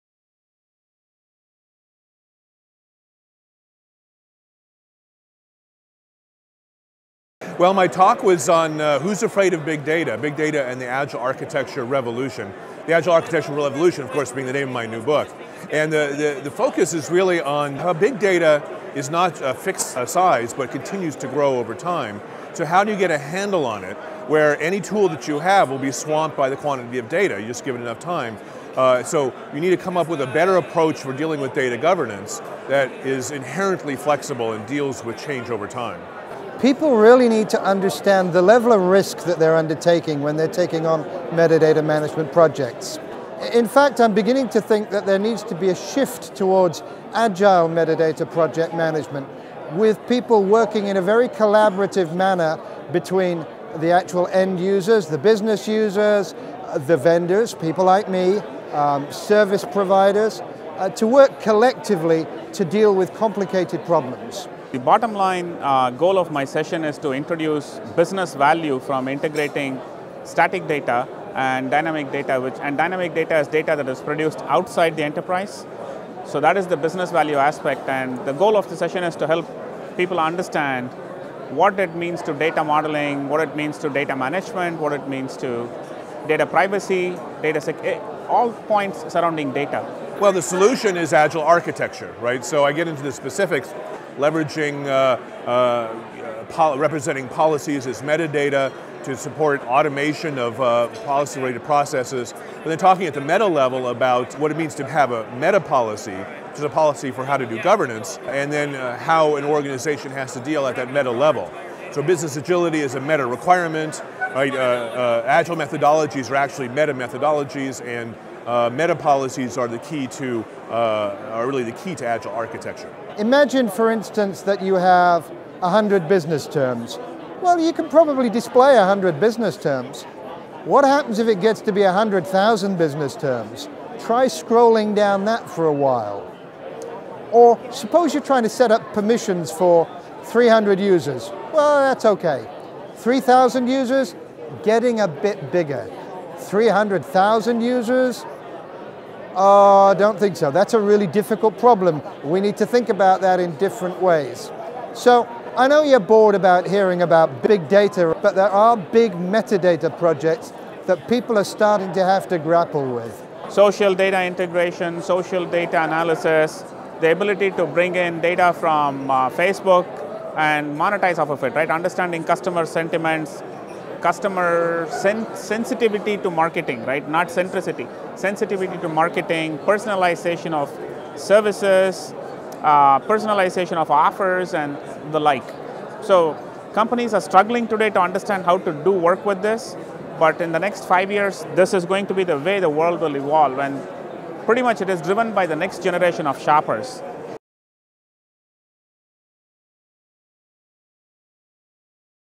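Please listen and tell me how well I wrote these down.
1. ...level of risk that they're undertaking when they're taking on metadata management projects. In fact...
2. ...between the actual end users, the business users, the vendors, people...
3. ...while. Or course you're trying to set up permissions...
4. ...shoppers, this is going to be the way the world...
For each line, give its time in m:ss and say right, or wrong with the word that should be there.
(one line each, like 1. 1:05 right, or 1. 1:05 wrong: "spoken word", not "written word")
1. 0:38 right
2. 0:52 right
3. 2:15 wrong: "suppose", not "course"
4. 3:11 wrong: "years", not "shoppers".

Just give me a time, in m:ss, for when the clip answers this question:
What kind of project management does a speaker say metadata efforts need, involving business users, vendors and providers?
0:47.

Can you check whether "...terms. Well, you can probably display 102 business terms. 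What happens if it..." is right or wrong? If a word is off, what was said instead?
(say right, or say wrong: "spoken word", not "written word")
wrong: "100", not "102".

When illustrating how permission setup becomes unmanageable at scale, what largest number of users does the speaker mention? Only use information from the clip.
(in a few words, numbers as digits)
300,000.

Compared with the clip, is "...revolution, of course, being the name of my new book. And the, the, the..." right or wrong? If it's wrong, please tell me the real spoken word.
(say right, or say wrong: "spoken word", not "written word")
right.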